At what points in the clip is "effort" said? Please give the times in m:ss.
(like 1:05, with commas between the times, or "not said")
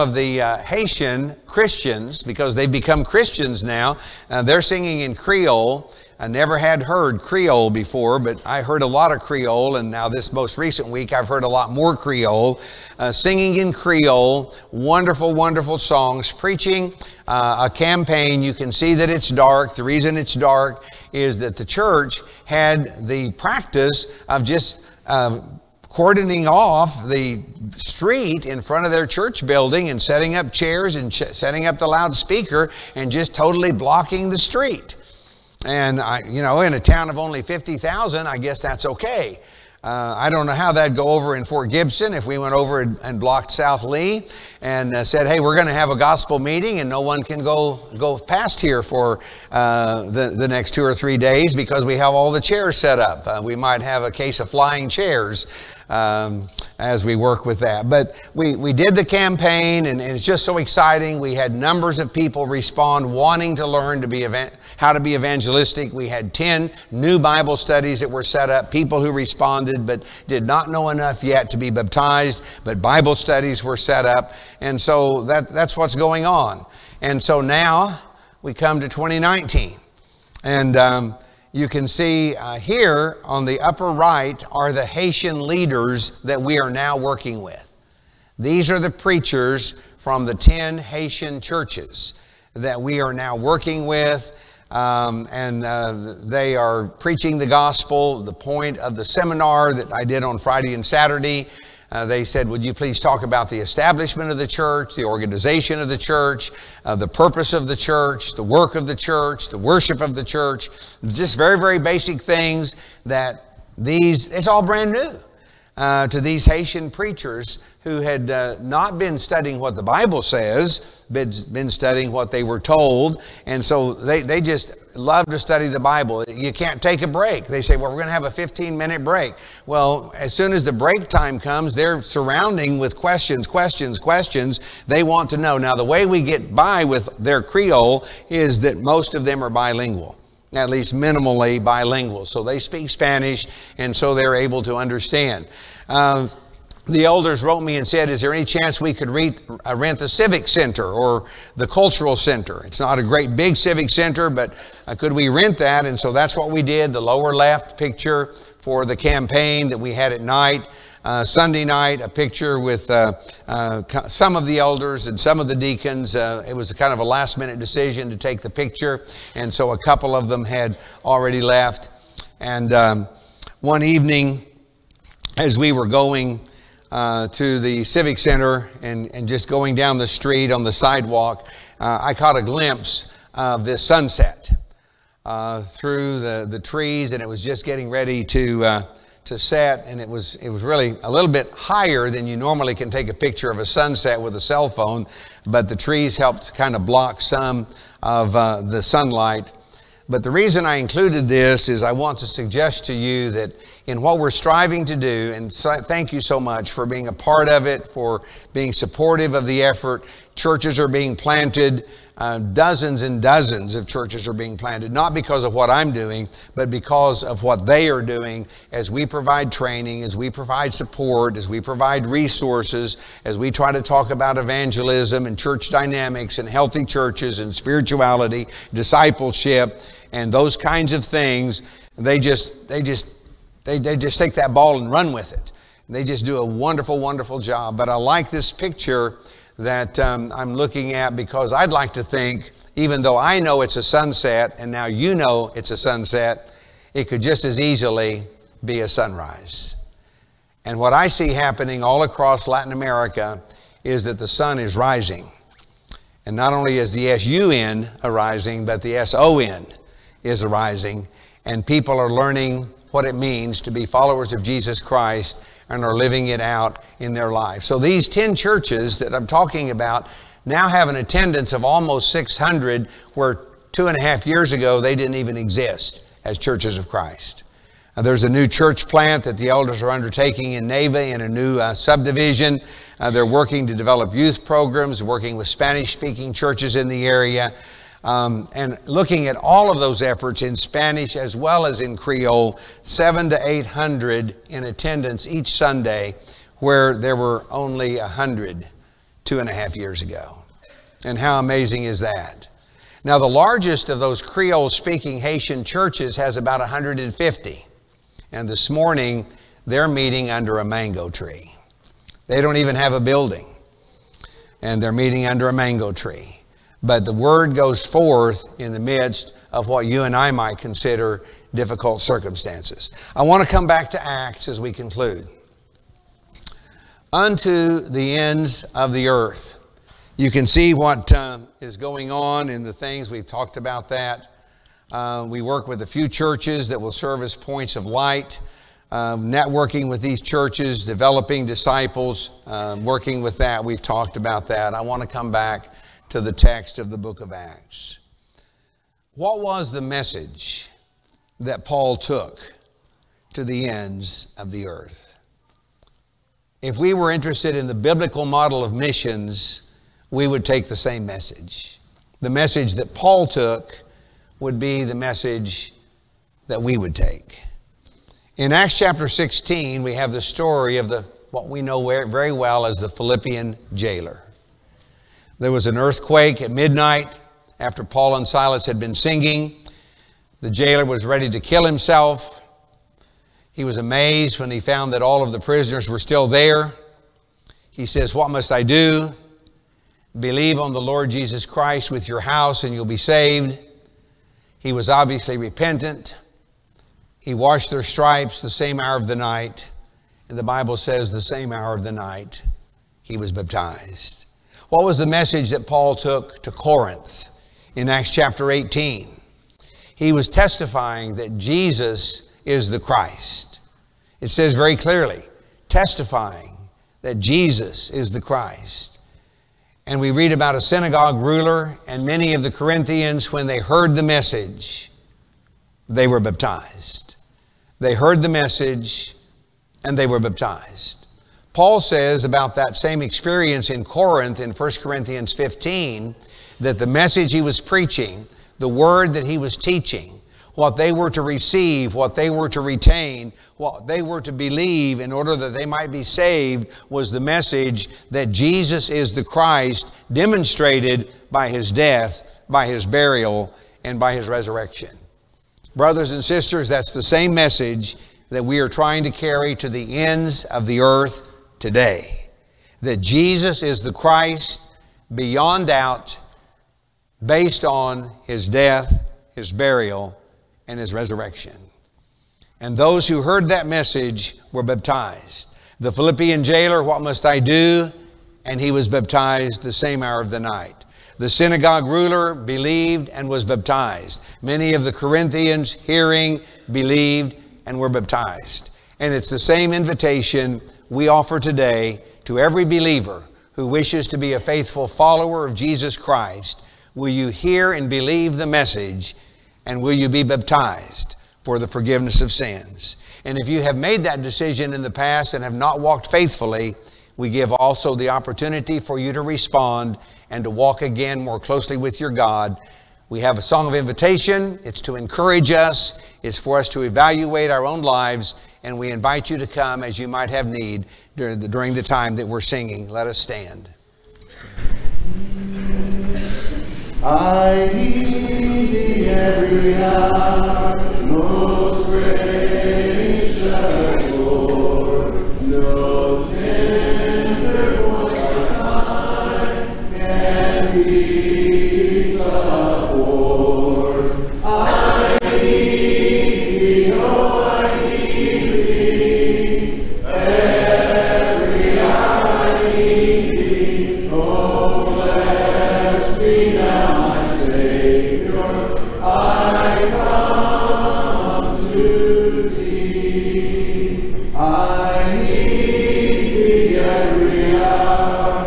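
3:29, 4:50.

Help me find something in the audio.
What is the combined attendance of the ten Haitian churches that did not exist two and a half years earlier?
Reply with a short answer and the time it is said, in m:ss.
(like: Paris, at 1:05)
almost 600, at 4:31.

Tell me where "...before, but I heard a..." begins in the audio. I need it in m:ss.
0:07.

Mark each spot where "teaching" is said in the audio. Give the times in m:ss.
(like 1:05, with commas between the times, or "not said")
7:19.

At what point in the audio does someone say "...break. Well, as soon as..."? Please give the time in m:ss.
2:09.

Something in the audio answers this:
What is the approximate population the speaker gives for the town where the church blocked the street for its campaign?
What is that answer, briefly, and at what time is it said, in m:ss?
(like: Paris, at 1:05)
50,000, at 0:37.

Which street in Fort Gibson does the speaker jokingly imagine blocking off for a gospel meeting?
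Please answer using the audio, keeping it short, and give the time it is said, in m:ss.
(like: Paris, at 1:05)
South Lee, at 0:43.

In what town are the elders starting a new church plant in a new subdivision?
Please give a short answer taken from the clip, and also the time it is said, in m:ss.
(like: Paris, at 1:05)
Neiba, at 4:40.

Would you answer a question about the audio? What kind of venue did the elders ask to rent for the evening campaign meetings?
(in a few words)
cultural center.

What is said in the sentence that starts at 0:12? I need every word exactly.
Uh, singing in Creole, wonderful, wonderful songs, preaching uh, a campaign.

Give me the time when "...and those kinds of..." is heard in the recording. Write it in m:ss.
3:50.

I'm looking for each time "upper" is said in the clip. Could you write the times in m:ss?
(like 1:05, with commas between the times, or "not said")
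1:23.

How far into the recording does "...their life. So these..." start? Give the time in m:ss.
4:27.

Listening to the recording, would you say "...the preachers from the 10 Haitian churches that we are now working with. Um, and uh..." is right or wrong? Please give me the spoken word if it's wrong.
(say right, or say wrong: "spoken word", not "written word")
right.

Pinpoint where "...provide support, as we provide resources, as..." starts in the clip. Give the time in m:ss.
3:40.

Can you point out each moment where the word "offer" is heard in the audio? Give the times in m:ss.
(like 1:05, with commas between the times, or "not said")
8:11.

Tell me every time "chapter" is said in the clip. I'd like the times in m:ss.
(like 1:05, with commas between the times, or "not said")
6:08, 6:48.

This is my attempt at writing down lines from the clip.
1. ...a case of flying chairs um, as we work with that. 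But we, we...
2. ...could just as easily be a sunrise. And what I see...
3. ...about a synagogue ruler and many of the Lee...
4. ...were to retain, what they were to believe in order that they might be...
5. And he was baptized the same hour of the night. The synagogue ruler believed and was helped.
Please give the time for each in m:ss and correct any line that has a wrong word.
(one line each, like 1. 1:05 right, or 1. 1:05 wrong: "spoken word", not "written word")
1. 0:54 right
2. 4:07 right
3. 7:00 wrong: "Corinthians", not "Lee"
4. 7:22 right
5. 7:58 wrong: "baptized", not "helped".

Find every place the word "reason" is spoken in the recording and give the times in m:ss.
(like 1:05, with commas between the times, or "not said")
0:19, 3:20.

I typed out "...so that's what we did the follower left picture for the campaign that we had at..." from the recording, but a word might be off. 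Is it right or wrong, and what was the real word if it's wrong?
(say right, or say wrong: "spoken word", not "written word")
wrong: "lower", not "follower".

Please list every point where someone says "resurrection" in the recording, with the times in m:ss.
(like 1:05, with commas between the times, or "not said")
7:34, 7:50.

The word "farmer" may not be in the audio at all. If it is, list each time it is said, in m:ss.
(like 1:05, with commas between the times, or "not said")
not said.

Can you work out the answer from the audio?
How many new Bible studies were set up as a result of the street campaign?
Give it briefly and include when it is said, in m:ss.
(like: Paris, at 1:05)
10, at 1:06.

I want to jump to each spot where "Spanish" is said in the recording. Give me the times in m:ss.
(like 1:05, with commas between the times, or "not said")
2:22, 4:45, 4:50.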